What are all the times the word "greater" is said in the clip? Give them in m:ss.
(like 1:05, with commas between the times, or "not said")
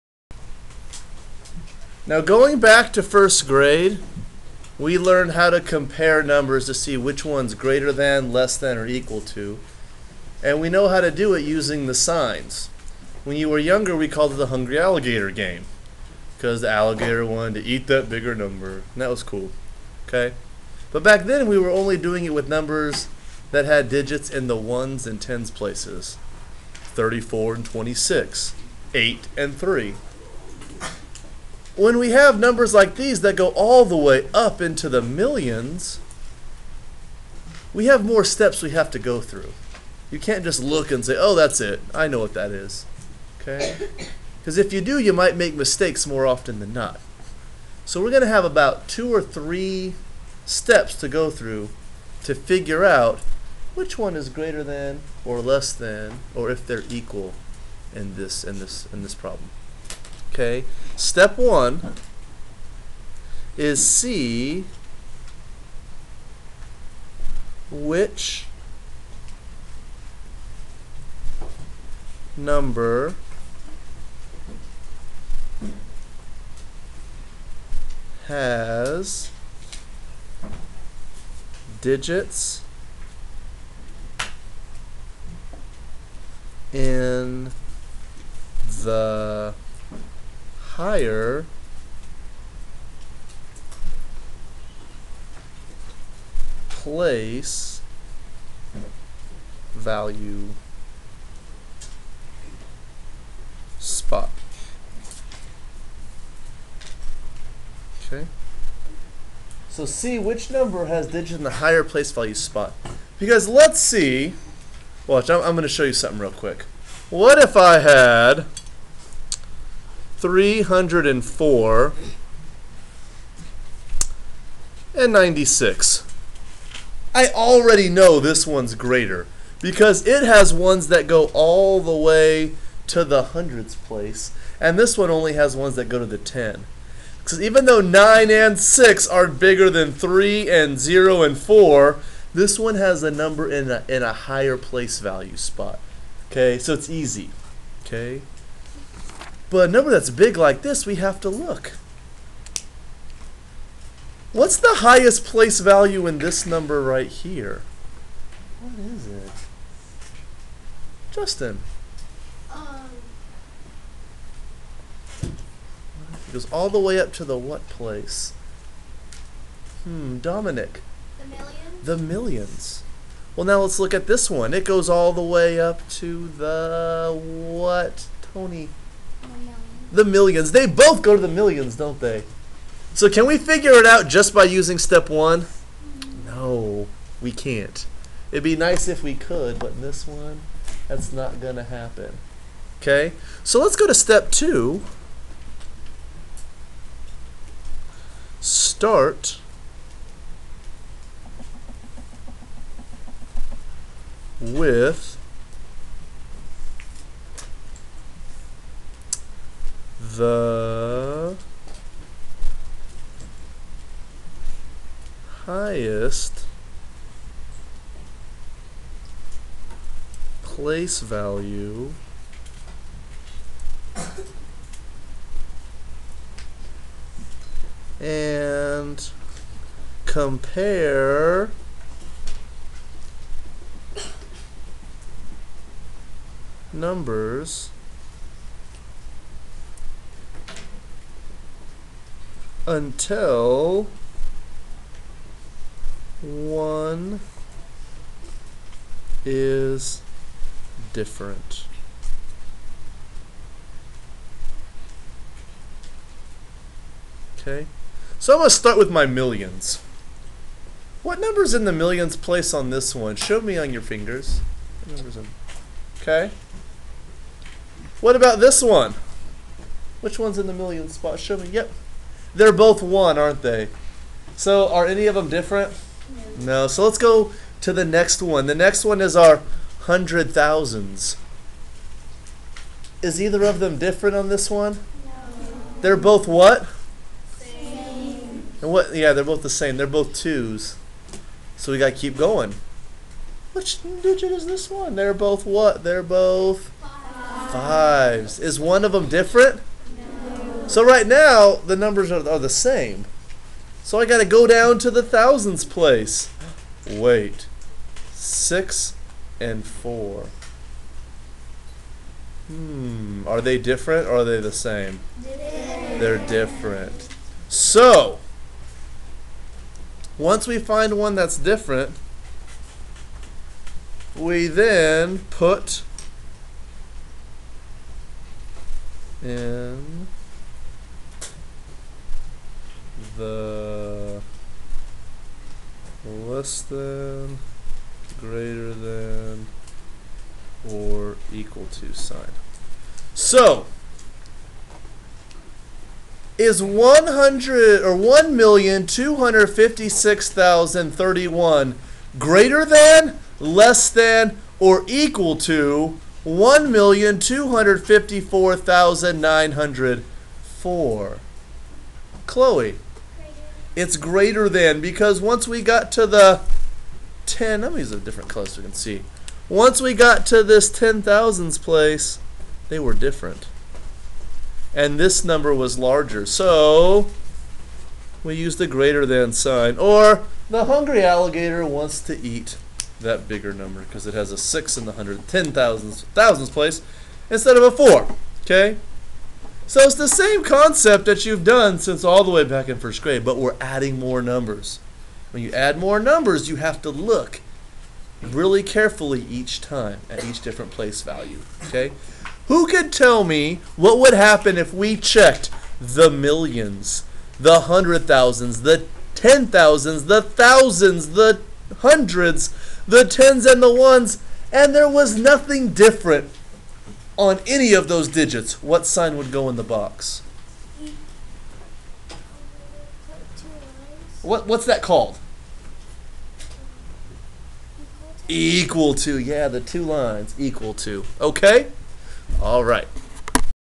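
0:07, 0:54, 2:08, 6:03, 6:18.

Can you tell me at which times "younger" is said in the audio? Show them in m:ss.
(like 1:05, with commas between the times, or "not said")
0:13.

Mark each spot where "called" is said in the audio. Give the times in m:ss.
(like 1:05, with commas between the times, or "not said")
0:14, 7:04.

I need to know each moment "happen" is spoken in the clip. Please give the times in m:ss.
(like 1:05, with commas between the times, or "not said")
3:11, 6:44.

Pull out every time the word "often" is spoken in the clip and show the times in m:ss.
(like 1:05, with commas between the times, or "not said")
0:46.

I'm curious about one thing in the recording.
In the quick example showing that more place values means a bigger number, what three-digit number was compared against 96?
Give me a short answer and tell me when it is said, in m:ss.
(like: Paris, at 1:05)
304, at 2:00.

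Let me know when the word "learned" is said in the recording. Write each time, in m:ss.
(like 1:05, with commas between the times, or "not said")
0:04.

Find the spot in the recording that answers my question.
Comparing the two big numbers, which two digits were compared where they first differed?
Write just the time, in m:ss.
5:08.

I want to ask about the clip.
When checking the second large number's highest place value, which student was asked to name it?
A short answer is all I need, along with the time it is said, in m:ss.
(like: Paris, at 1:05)
Tony, at 2:58.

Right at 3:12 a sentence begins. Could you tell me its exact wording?
Okay, so let's go to step two.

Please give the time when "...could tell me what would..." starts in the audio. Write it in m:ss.
6:42.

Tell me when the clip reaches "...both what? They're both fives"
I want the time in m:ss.
4:55.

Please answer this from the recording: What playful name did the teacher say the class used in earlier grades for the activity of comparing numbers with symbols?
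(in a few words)
hungry alligator game.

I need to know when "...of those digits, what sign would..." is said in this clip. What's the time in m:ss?
6:57.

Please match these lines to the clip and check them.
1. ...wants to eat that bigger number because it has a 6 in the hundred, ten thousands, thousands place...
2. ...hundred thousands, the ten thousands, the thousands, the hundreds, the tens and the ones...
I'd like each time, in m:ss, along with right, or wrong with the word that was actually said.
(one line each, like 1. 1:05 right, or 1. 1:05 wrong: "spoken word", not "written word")
1. 6:21 right
2. 6:47 right.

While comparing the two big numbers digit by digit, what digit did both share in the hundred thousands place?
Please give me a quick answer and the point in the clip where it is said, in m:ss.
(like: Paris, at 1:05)
2, at 4:50.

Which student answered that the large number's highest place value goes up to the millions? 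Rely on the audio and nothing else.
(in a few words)
Dominic.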